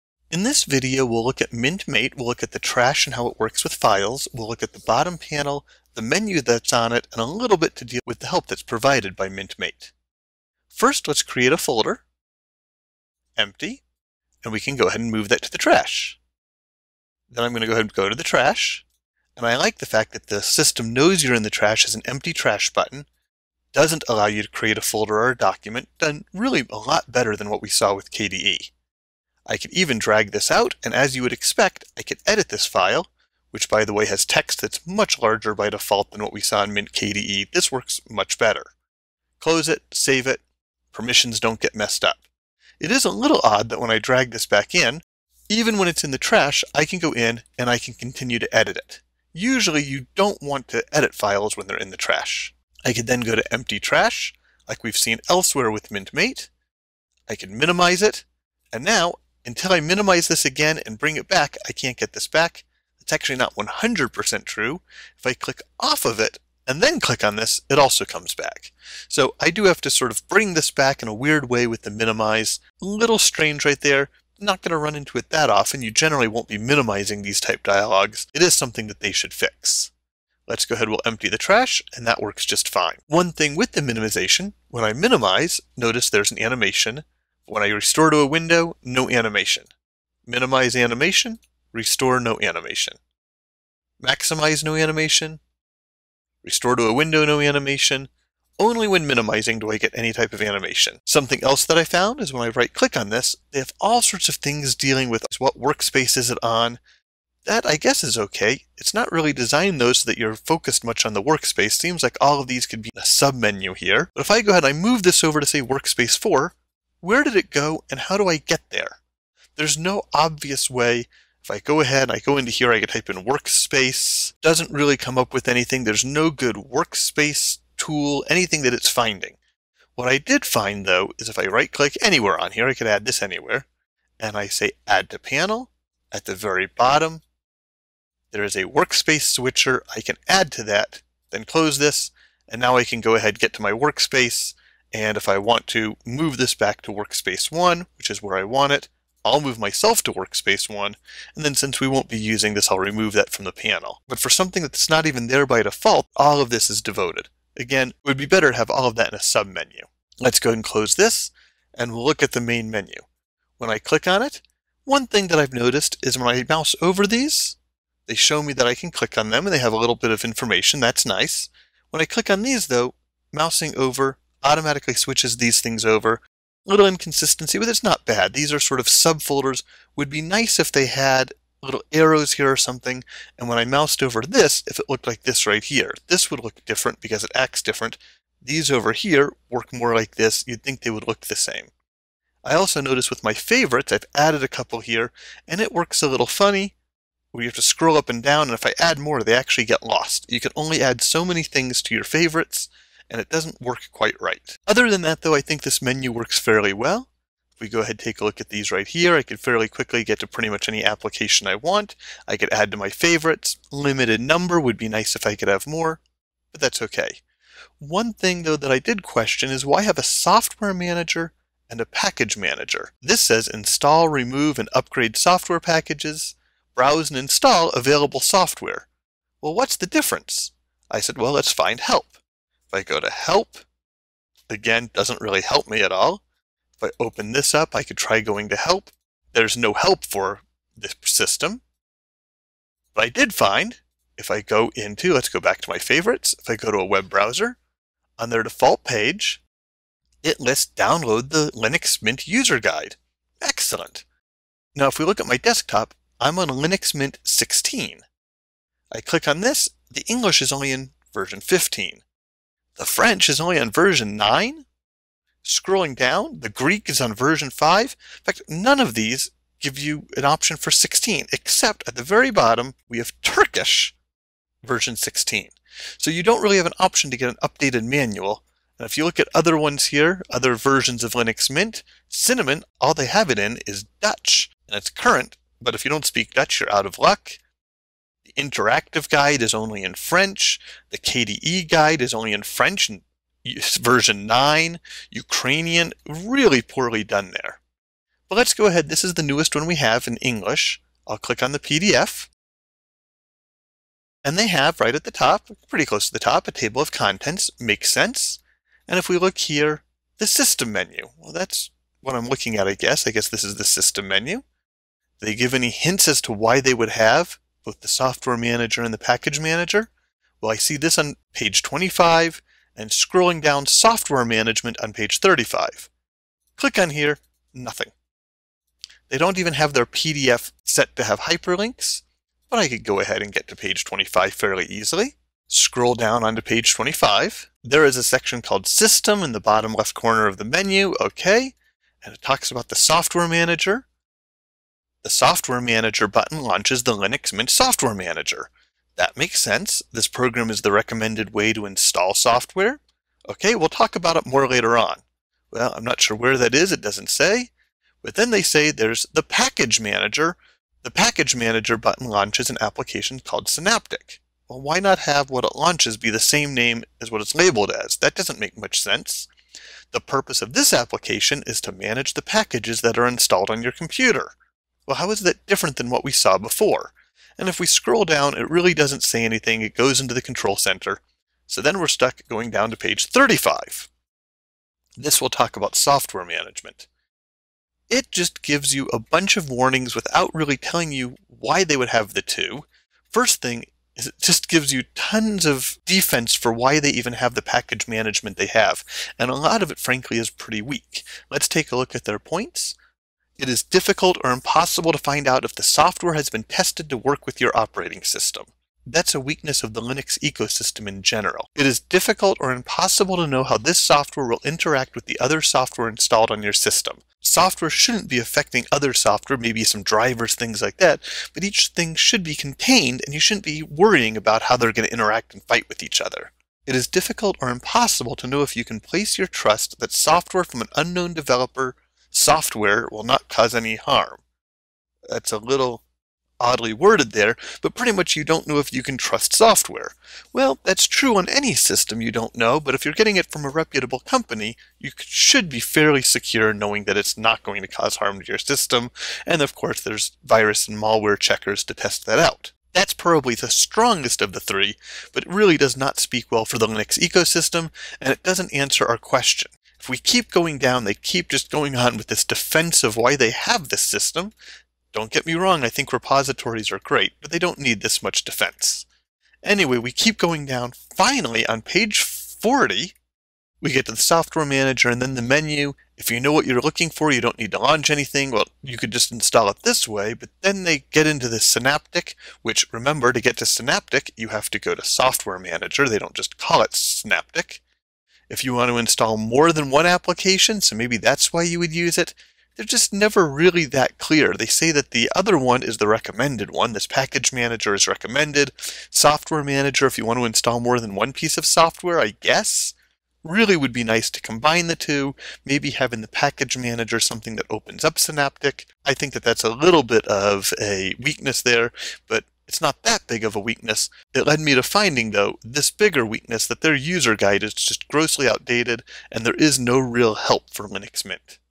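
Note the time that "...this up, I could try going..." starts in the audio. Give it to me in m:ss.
3:57.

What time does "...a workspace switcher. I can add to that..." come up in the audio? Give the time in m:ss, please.
2:18.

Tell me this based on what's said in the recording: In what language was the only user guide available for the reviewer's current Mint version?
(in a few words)
Turkish.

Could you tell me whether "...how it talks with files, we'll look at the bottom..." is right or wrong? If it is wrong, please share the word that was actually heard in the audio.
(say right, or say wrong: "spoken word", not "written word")
wrong: "works", not "talks".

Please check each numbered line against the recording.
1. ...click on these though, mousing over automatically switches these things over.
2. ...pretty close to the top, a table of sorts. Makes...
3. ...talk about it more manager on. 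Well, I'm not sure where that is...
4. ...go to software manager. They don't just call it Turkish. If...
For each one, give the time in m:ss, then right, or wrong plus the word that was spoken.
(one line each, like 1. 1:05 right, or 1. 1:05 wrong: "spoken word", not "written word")
1. 2:52 right
2. 5:05 wrong: "contents", not "sorts"
3. 5:53 wrong: "later", not "manager"
4. 8:04 wrong: "Synaptic", not "Turkish".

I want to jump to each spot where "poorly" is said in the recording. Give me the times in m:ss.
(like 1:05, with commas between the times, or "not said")
4:56.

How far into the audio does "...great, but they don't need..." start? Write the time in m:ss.
7:46.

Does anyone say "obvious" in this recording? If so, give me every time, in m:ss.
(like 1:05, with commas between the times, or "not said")
2:00.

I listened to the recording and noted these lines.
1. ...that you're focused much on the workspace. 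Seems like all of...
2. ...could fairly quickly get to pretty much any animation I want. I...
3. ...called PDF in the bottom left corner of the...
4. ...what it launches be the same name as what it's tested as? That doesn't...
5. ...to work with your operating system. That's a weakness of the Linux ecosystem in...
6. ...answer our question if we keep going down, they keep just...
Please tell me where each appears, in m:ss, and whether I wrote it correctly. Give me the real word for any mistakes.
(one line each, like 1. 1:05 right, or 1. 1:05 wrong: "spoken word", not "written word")
1. 1:50 right
2. 3:29 wrong: "application", not "animation"
3. 5:38 wrong: "System", not "PDF"
4. 6:05 wrong: "labeled", not "tested"
5. 6:46 right
6. 7:38 right.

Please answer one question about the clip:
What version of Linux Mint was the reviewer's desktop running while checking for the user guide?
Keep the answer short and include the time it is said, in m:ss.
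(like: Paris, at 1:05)
16, at 4:16.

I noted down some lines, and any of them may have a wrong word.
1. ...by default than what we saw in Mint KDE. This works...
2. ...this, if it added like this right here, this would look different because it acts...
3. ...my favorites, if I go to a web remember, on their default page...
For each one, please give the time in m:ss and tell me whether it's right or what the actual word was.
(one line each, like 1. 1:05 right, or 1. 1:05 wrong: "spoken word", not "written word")
1. 0:35 right
2. 3:04 wrong: "looked", not "added"
3. 4:05 wrong: "browser", not "remember".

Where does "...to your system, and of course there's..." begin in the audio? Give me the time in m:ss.
7:28.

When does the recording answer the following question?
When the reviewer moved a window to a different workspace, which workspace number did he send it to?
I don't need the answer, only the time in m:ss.
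1:55.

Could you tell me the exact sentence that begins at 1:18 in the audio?
It is something that they should fix.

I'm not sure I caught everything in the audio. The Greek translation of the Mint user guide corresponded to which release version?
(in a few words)
5.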